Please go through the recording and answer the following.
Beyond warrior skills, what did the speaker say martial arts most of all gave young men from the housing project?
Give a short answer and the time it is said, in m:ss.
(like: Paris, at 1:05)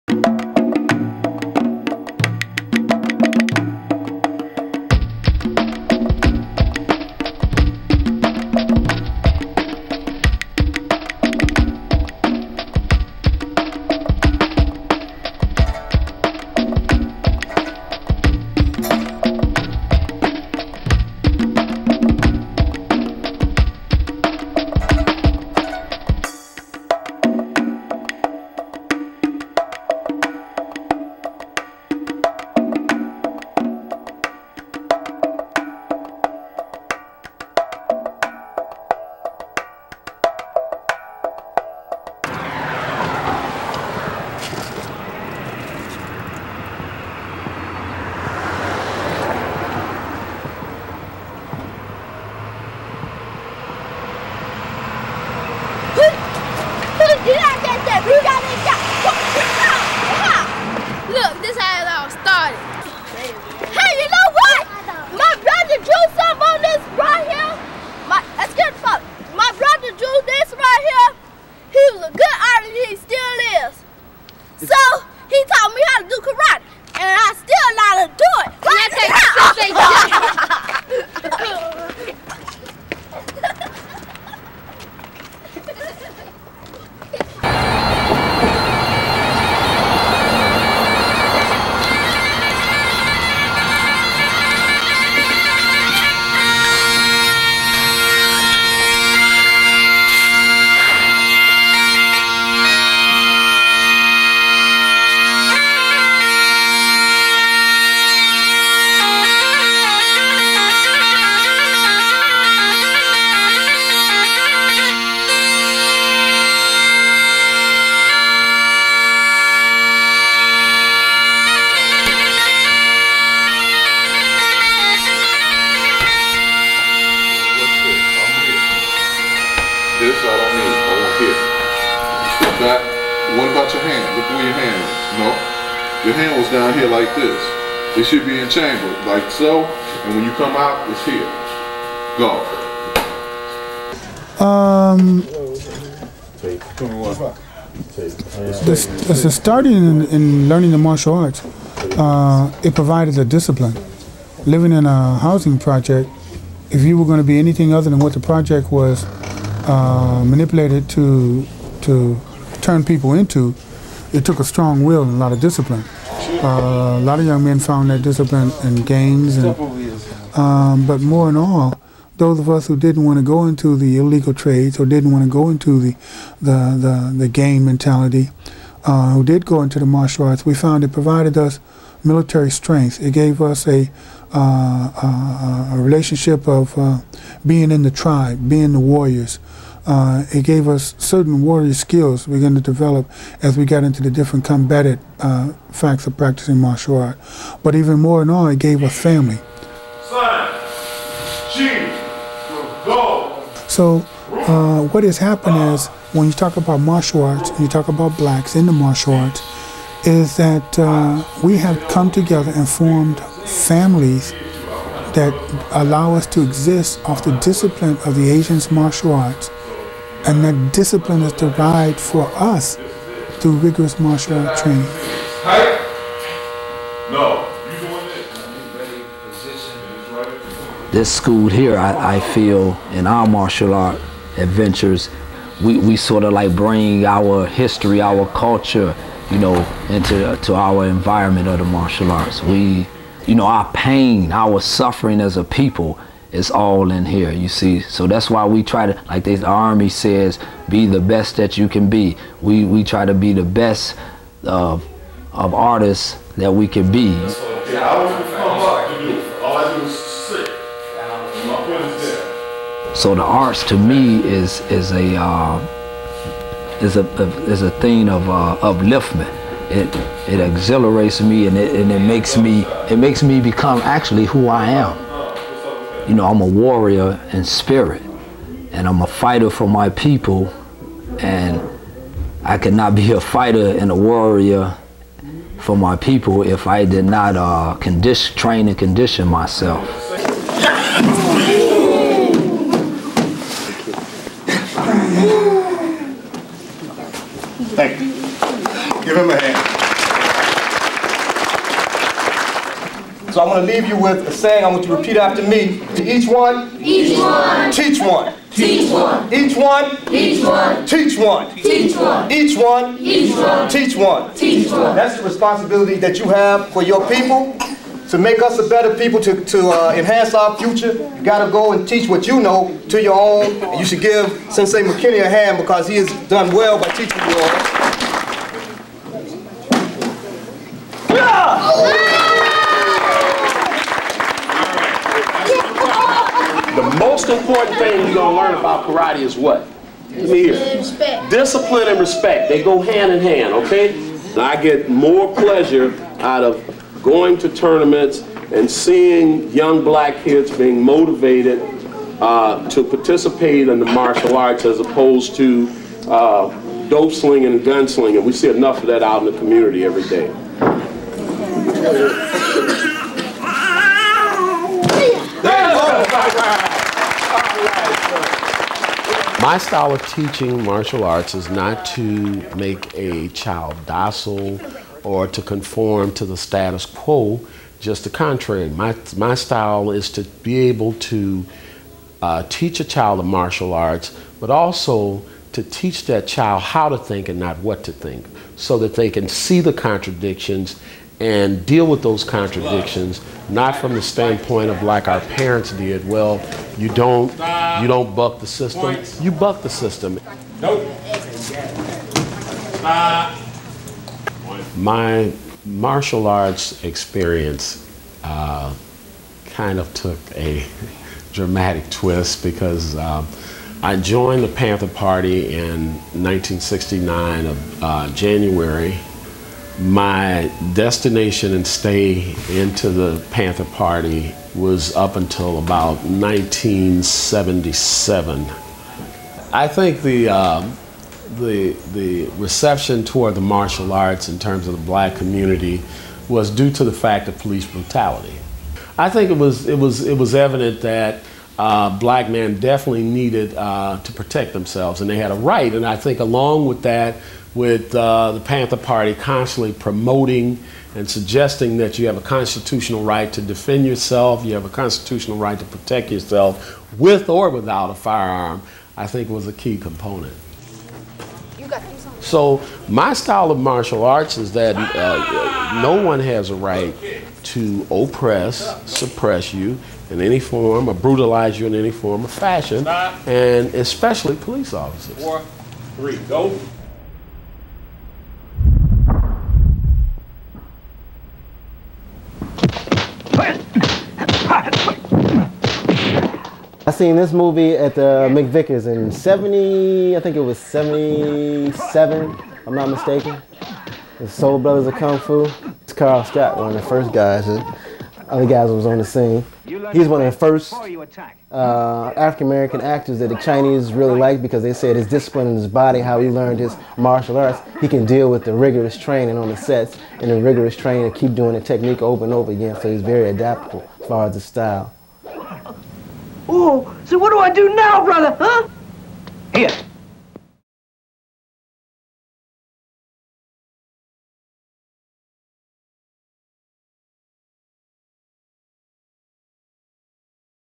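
Family, at 3:18.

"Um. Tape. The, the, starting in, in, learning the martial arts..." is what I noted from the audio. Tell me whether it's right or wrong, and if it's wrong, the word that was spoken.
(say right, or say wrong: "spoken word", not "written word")
right.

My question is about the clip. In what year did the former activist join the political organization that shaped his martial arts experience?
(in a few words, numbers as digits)
1969.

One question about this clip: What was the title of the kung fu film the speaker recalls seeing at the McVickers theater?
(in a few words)
The Soul Brothers of Kung Fu.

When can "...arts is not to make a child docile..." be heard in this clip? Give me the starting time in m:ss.
6:11.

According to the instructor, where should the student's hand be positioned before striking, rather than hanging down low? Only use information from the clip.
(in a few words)
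In chamber.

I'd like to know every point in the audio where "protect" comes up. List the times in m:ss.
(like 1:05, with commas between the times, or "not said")
7:24, 7:35.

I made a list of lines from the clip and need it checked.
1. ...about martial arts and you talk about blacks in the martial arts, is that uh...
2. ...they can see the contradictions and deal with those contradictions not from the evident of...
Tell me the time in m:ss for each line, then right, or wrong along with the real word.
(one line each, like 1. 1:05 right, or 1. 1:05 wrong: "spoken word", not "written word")
1. 3:26 right
2. 6:28 wrong: "standpoint", not "evident".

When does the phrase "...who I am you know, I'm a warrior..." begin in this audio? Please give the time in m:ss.
4:34.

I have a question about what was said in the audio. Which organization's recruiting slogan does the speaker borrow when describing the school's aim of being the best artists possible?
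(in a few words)
The Army.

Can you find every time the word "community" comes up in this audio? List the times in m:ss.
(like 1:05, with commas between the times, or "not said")
5:59, 7:15.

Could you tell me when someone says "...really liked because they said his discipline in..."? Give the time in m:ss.
8:23.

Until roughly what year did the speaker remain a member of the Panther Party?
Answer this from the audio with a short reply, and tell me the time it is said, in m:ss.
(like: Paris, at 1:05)
1977, at 7:06.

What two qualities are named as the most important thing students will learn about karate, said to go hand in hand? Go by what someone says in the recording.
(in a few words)
Discipline and respect.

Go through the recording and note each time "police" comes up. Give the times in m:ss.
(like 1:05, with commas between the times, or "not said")
7:17, 7:54.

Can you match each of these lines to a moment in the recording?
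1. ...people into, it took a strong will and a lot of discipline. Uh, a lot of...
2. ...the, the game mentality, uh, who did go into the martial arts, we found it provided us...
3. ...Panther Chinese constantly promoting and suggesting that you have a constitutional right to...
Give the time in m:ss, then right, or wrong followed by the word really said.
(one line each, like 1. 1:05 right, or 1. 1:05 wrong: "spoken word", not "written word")
1. 2:42 right
2. 2:56 right
3. 7:28 wrong: "Party", not "Chinese".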